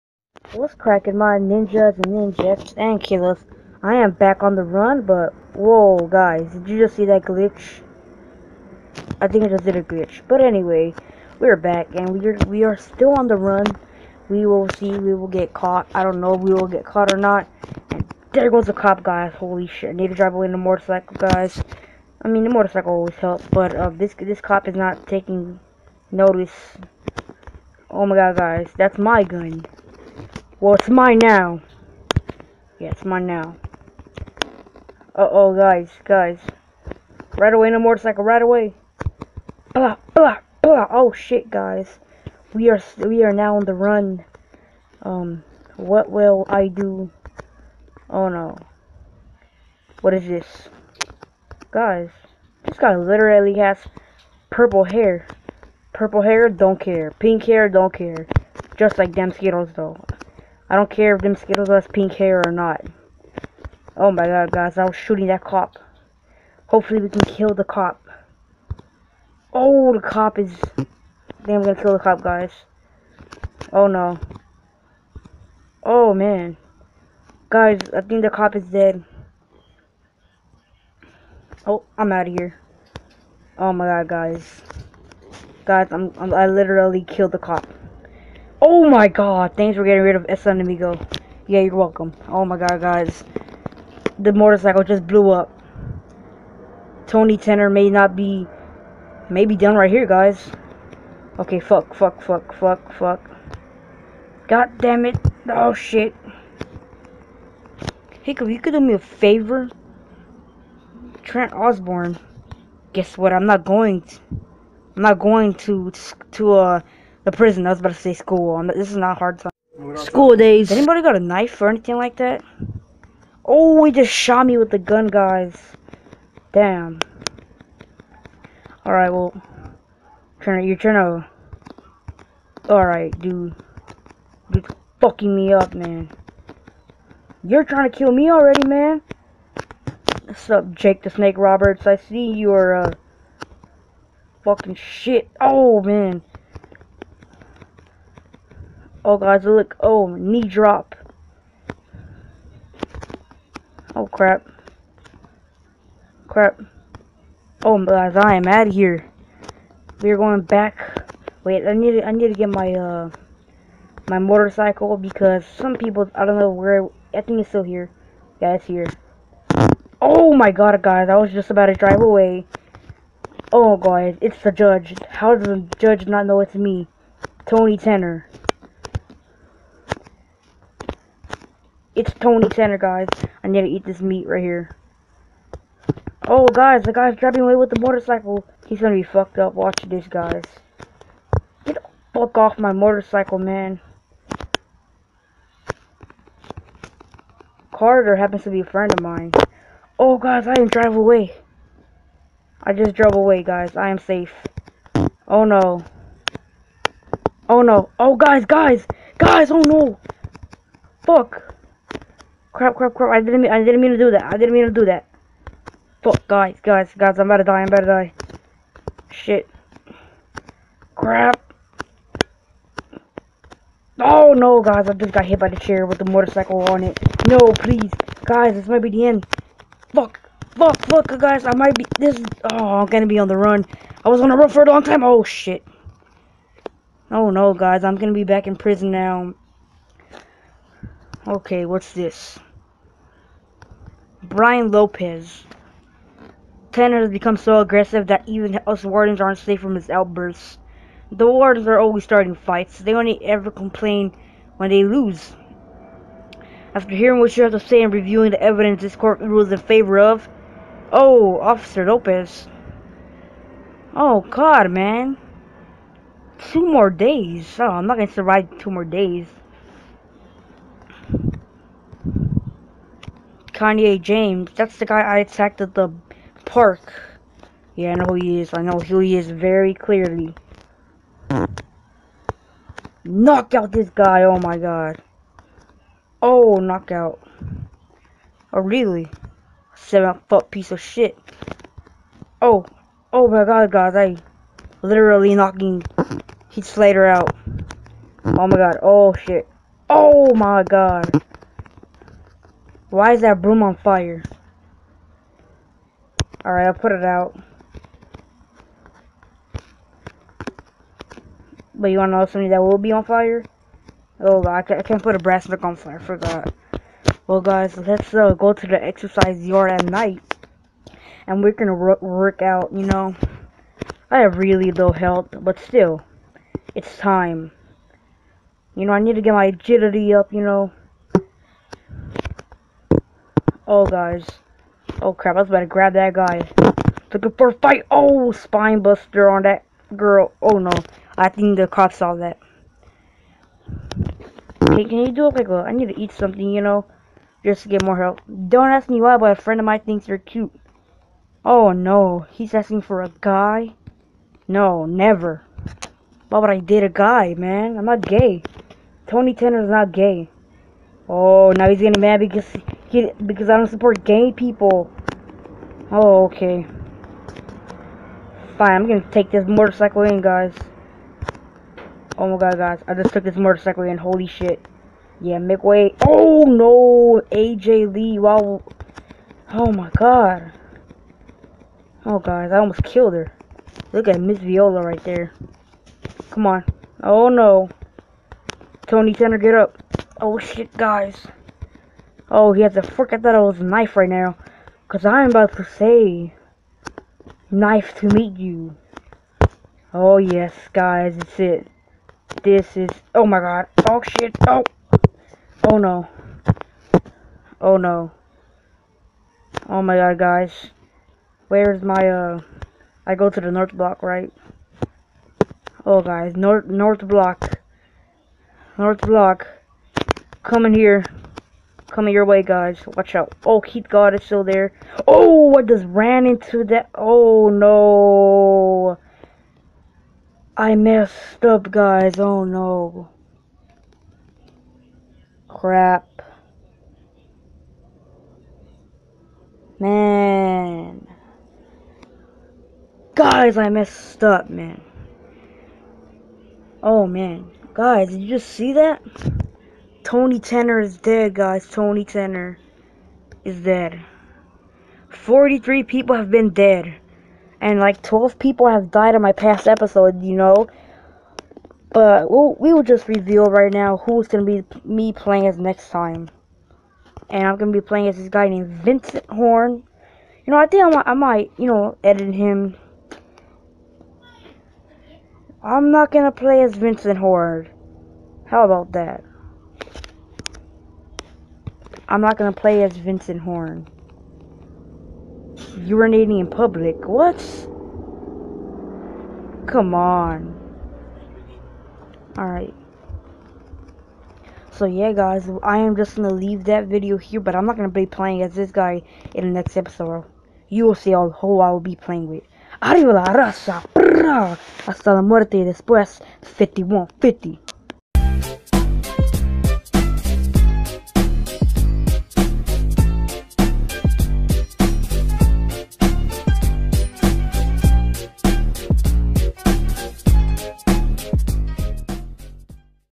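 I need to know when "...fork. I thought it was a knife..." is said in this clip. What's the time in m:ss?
6:32.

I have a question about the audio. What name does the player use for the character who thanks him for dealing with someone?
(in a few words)
Sunamigo.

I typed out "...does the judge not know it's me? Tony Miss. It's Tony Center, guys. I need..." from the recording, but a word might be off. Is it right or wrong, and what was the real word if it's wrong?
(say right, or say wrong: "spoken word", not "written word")
wrong: "Tanner", not "Miss".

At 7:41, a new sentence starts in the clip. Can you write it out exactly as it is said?
But we'll, we'll just reveal right now who's going to be me playing as next time.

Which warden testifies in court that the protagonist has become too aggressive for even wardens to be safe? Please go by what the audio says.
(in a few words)
Brian Lopez.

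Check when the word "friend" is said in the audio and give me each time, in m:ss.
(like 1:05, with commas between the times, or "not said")
3:18, 5:49.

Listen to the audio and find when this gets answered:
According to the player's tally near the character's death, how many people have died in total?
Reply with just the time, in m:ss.
7:35.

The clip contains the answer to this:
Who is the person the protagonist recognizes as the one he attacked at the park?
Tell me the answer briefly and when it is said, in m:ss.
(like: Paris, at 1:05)
Kanye James, at 4:33.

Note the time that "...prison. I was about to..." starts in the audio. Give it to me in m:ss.
1:57.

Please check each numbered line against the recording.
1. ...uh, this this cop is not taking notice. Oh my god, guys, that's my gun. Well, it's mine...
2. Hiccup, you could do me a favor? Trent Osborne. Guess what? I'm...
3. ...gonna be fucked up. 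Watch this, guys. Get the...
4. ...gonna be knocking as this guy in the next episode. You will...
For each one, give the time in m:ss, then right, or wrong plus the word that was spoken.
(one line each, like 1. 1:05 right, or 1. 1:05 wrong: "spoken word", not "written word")
1. 0:23 right
2. 1:48 right
3. 3:08 right
4. 8:17 wrong: "playing", not "knocking".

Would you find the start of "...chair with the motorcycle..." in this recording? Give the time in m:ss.
3:45.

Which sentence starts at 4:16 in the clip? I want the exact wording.
After hearing what you have to say and reviewing the evidence this court rules in favor of...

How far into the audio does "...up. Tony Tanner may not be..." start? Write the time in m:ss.
1:35.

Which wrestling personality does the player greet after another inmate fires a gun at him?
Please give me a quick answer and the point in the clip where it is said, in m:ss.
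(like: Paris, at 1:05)
Jake the Snake Roberts, at 2:20.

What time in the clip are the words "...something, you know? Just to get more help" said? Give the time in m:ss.
5:46.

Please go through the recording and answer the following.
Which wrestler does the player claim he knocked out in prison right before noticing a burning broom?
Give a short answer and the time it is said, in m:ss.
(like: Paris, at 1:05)
Heath Slater, at 4:56.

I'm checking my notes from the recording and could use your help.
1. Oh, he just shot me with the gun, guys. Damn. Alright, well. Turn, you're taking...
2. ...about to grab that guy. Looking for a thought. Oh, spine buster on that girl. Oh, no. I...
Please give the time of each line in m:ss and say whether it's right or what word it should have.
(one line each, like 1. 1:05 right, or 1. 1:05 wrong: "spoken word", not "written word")
1. 2:03 wrong: "trying", not "taking"
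2. 5:35 wrong: "fight", not "thought".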